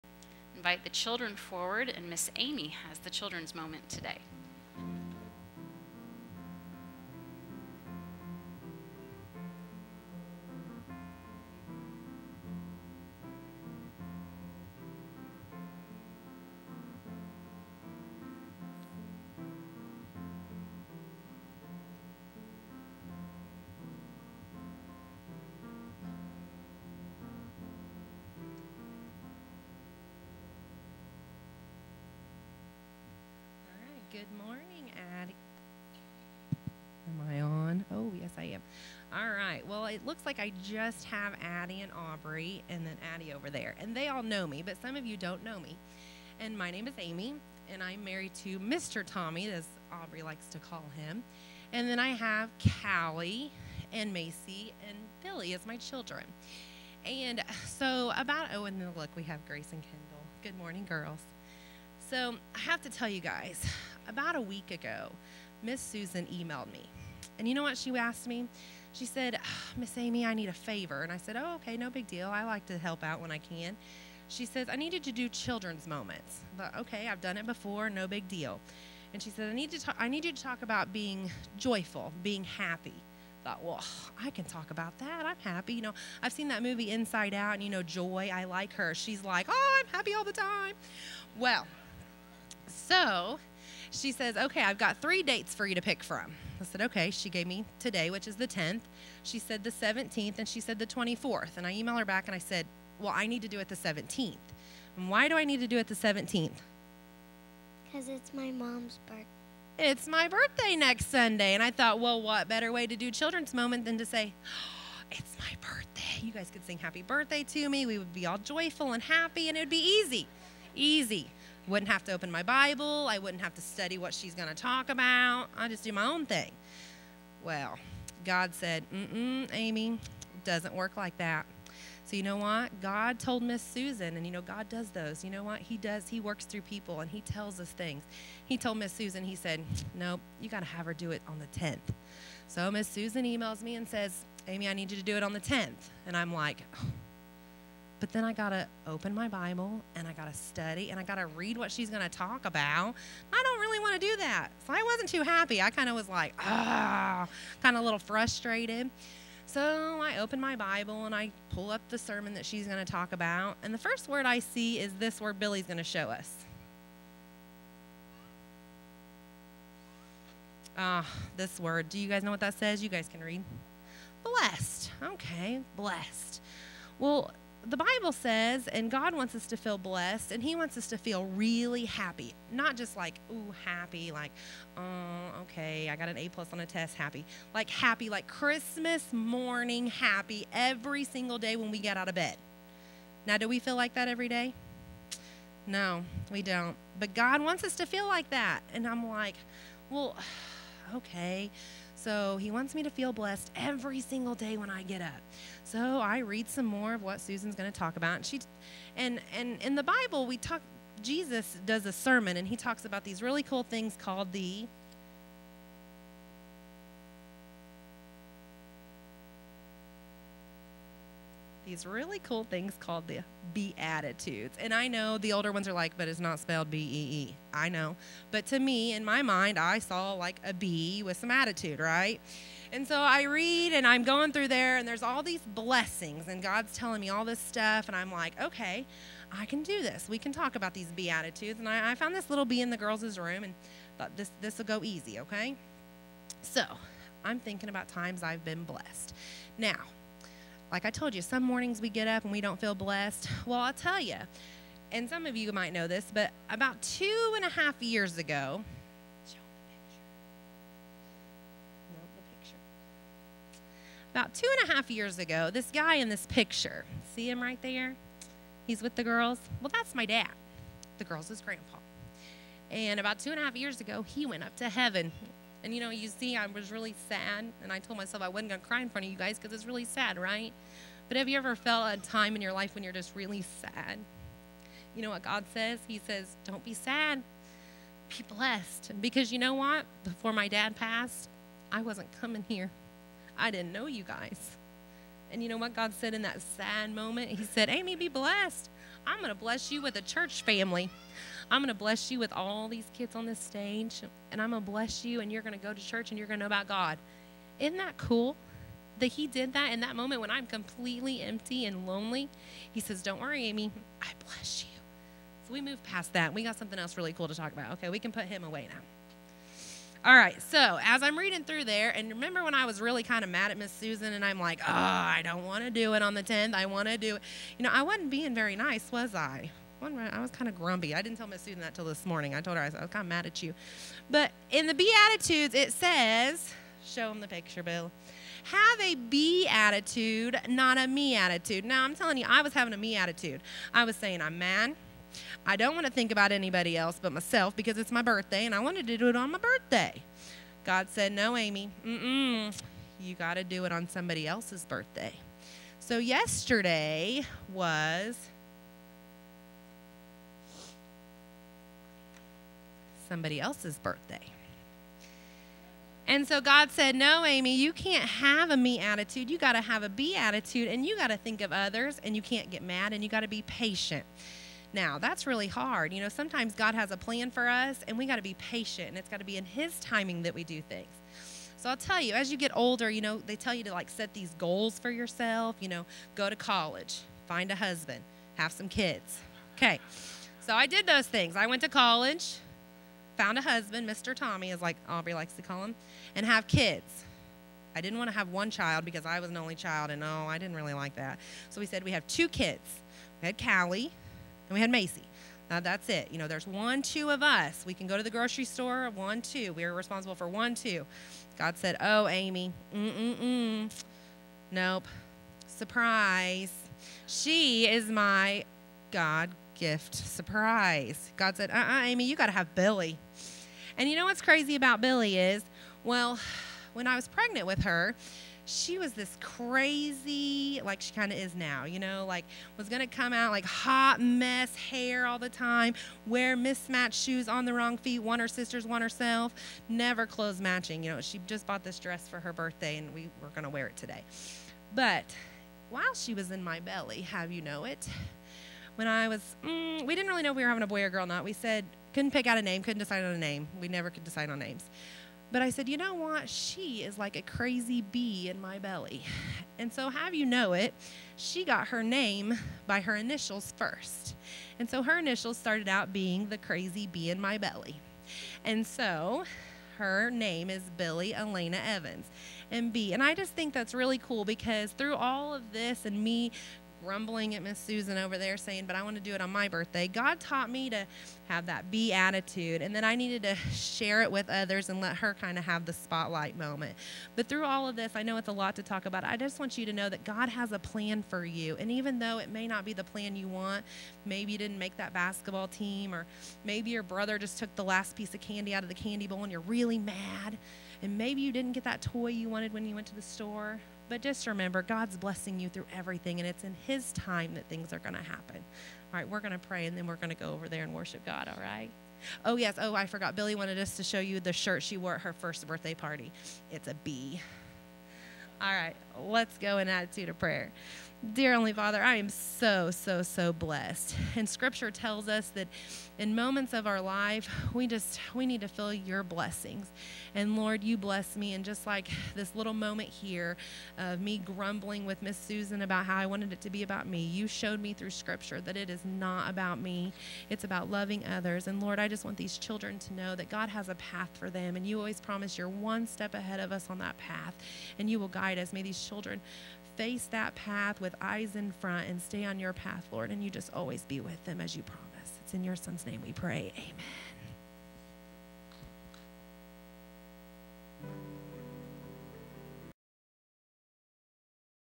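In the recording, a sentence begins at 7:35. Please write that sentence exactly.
But I said, you know what?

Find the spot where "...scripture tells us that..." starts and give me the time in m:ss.
8:44.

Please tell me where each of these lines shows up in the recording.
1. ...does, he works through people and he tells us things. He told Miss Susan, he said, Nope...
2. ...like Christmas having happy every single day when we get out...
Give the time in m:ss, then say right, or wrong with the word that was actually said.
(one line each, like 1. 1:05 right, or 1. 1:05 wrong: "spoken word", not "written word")
1. 2:15 right
2. 3:08 wrong: "morning", not "having".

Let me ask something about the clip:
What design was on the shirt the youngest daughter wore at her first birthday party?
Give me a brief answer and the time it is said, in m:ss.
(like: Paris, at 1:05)
A bee, at 8:36.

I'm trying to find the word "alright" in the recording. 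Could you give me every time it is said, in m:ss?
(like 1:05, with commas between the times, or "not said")
not said.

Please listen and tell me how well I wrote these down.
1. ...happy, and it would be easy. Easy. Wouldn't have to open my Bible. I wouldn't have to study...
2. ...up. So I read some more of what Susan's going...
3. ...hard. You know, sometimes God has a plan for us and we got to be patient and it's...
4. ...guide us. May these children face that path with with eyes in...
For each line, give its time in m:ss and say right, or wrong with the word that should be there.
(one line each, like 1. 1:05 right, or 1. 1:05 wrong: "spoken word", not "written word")
1. 1:59 right
2. 3:25 right
3. 6:15 right
4. 9:08 right.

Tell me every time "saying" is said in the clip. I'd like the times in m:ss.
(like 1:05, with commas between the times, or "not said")
5:43, 7:58.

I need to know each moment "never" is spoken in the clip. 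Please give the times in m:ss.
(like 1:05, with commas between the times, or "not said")
7:19, 7:33.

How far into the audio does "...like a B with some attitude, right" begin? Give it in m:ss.
3:50.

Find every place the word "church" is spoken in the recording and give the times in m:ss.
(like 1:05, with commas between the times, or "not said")
5:00, 5:05.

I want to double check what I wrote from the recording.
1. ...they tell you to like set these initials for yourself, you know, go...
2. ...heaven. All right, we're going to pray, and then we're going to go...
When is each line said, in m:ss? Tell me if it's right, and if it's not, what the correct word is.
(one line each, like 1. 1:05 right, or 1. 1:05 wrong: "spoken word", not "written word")
1. 6:23 wrong: "goals", not "initials"
2. 8:28 wrong: "happen", not "heaven".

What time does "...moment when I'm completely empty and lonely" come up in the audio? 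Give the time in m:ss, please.
5:09.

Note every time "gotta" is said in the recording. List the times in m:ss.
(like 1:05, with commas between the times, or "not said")
2:20.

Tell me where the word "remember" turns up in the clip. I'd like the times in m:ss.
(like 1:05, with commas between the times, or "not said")
5:22, 8:24.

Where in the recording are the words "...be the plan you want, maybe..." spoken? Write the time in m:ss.
8:12.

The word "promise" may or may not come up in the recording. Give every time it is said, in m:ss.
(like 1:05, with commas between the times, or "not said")
9:05, 9:14.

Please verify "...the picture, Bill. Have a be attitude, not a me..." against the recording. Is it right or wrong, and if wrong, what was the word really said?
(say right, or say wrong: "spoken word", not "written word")
right.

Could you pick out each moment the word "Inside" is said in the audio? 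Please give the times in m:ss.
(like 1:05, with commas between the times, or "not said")
1:26.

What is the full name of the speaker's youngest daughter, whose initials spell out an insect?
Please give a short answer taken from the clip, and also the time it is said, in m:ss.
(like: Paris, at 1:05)
Billy Elena Evans, at 7:50.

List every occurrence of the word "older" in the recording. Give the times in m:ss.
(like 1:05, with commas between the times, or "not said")
3:45, 6:22.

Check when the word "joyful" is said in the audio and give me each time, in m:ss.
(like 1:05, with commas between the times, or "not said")
1:21, 1:58.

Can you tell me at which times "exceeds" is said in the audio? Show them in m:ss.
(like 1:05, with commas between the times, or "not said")
not said.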